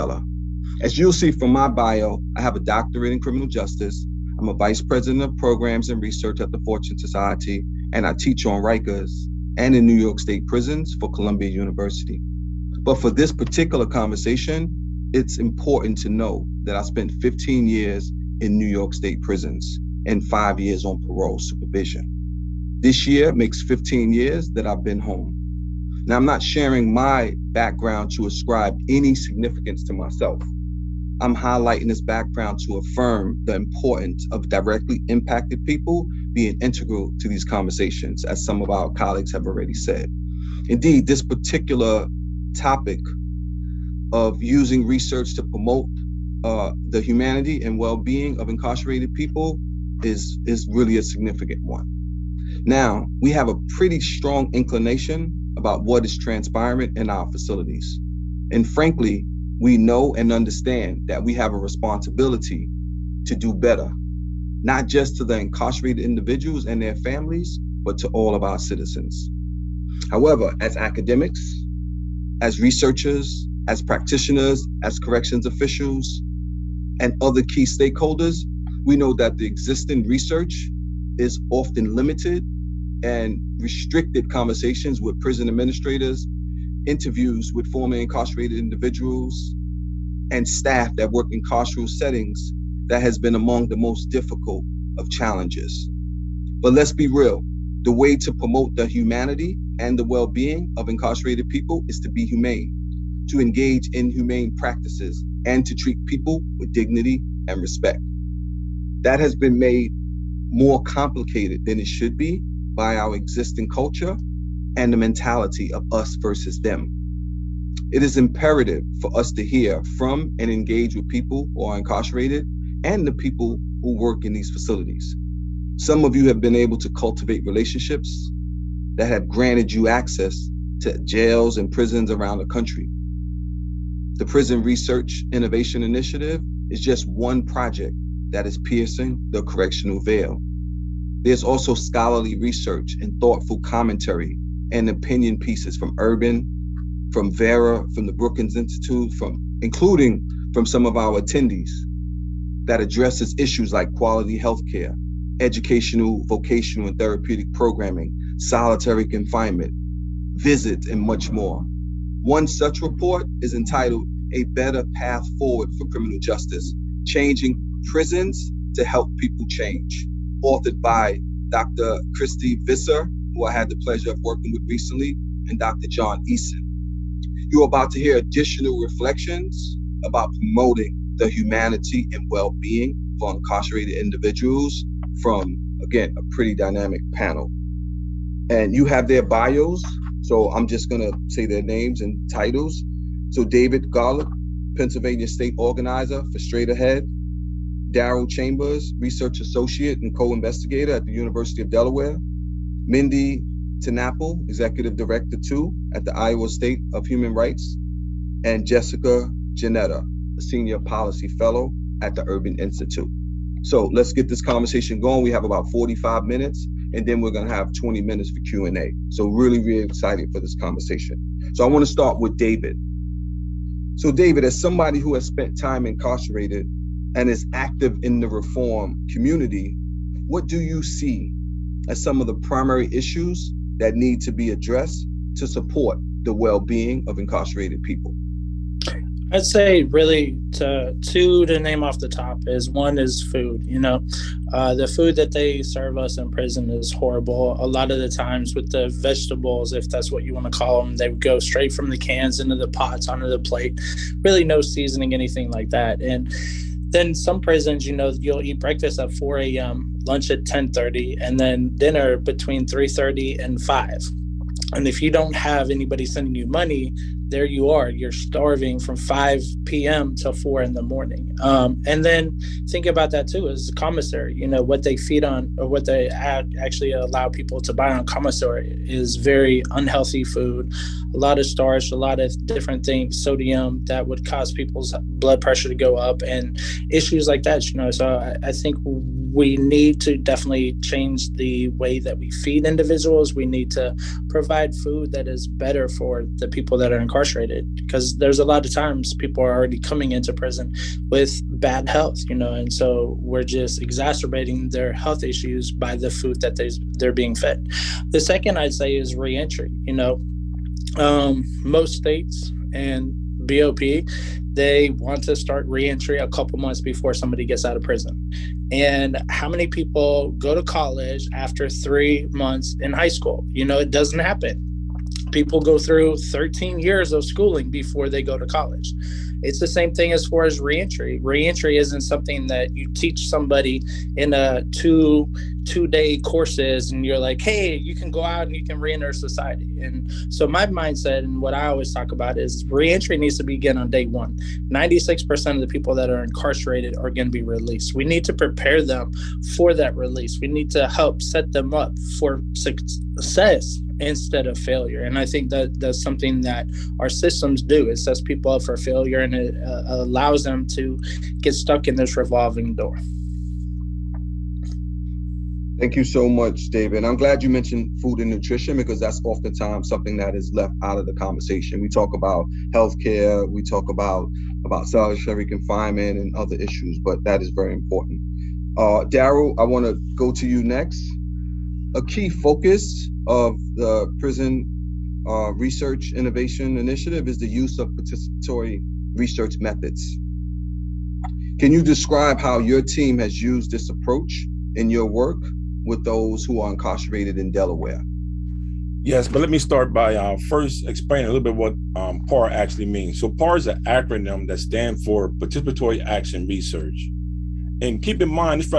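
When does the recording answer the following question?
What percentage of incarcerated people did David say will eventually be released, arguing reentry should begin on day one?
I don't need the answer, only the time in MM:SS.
05:44.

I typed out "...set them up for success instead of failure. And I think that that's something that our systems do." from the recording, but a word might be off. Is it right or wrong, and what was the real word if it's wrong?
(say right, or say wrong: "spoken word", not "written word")
right.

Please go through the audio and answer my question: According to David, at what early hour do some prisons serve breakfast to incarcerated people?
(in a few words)
4 a.m.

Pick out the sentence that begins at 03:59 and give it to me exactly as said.
I'd say really to two to name off the top is one is food.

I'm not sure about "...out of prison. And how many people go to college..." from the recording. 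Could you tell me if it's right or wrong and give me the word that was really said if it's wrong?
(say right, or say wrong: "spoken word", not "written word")
right.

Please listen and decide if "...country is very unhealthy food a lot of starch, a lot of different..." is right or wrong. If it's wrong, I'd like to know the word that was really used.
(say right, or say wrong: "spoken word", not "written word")
wrong: "commissary", not "country".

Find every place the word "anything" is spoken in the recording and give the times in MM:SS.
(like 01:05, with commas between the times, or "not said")
04:15.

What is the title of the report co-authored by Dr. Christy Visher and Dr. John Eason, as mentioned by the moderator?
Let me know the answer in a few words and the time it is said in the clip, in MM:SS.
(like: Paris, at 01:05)
A Better Path Forward for Criminal Justice, at 02:44.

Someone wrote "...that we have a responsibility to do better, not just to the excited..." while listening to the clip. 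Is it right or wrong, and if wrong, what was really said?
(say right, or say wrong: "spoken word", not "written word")
wrong: "incarcerated", not "excited".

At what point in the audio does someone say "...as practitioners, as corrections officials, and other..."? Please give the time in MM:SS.
01:13.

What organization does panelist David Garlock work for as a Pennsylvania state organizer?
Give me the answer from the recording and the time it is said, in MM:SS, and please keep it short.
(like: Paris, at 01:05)
Straight Ahead, at 03:16.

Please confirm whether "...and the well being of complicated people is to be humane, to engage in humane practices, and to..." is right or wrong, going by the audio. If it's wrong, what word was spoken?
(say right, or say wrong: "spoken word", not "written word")
wrong: "incarcerated", not "complicated".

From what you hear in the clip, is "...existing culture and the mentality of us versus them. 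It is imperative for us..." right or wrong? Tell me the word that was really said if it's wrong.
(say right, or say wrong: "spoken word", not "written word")
right.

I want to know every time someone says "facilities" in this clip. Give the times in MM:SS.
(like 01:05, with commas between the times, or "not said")
00:57, 02:04.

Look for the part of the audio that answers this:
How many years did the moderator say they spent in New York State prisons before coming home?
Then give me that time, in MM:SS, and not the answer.
00:17.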